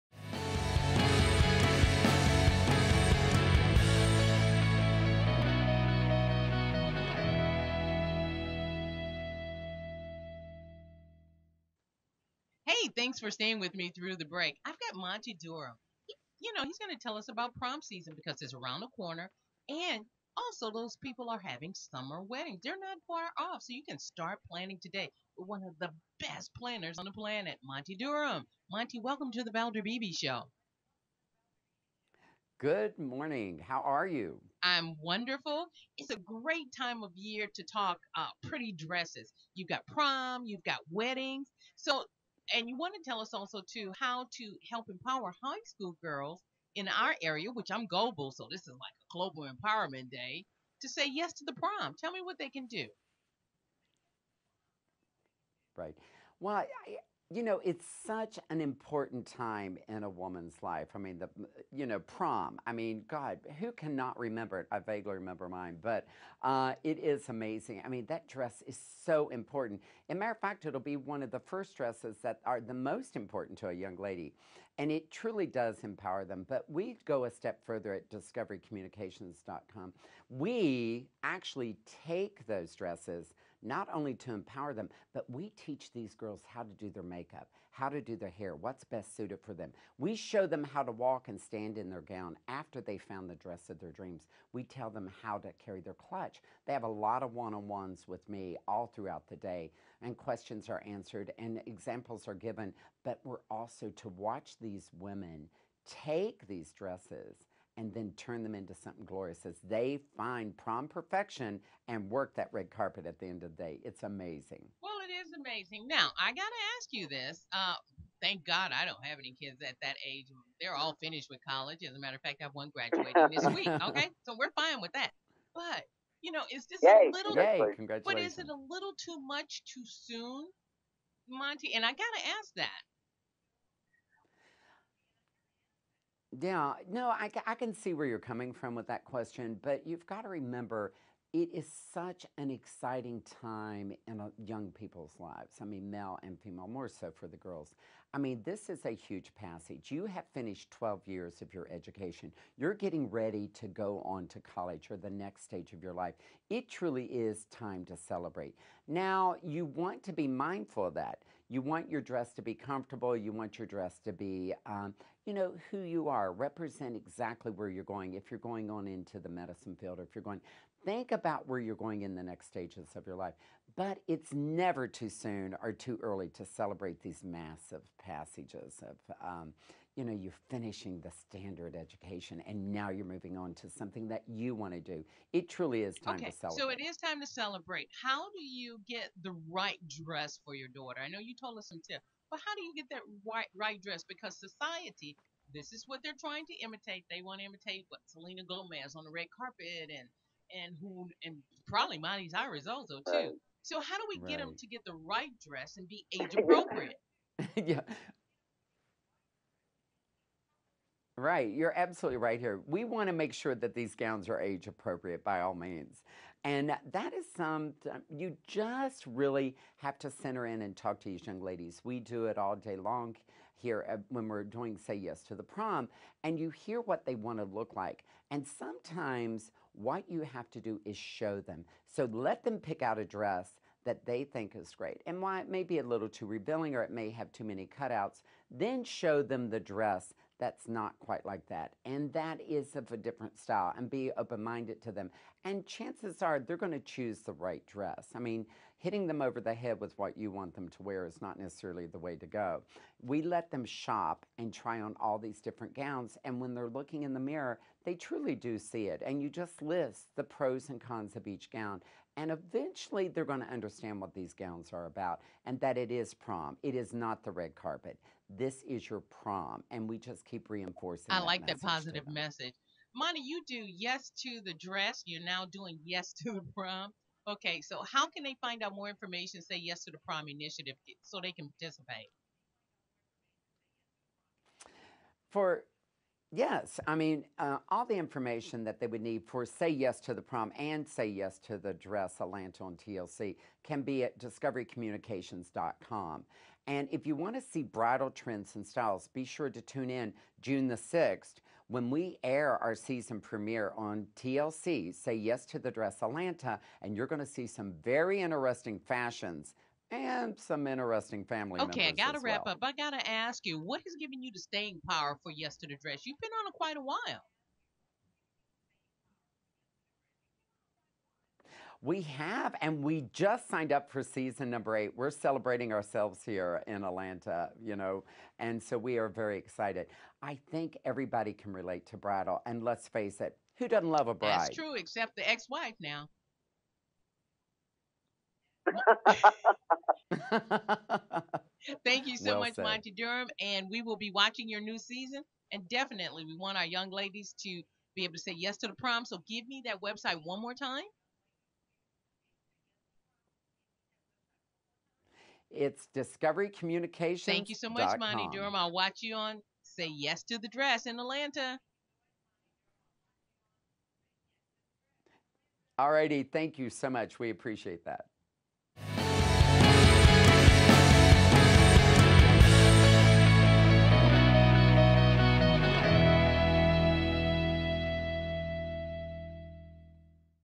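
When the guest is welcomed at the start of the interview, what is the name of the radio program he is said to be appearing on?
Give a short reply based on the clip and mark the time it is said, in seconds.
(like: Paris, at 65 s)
The Valder Beebe Show, at 29 s.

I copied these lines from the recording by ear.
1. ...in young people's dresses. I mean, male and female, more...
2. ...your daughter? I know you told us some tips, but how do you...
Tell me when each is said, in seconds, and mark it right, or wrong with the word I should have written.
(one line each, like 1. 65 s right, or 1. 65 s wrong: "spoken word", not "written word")
1. 144 s wrong: "lives", not "dresses"
2. 190 s right.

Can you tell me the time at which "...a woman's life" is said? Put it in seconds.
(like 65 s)
60 s.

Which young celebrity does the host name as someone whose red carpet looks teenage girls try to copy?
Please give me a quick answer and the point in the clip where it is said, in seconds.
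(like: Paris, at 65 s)
Selena Gomez, at 198 s.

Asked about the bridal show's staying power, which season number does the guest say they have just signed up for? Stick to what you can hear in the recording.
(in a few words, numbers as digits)
8.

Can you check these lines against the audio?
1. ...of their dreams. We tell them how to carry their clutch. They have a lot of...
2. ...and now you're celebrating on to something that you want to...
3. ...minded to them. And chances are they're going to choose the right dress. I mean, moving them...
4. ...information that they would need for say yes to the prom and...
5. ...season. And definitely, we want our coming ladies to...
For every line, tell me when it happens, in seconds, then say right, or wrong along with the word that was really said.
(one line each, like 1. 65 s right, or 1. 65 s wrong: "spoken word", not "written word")
1. 93 s right
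2. 182 s wrong: "moving", not "celebrating"
3. 244 s wrong: "hitting", not "moving"
4. 287 s right
5. 344 s wrong: "young", not "coming".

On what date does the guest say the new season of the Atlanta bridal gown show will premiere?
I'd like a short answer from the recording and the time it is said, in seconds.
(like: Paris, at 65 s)
June 6, at 300 s.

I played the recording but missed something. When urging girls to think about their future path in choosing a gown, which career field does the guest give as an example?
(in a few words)
medicine.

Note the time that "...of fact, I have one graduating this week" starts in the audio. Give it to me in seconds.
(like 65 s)
122 s.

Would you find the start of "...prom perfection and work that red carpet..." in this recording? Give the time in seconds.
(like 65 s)
110 s.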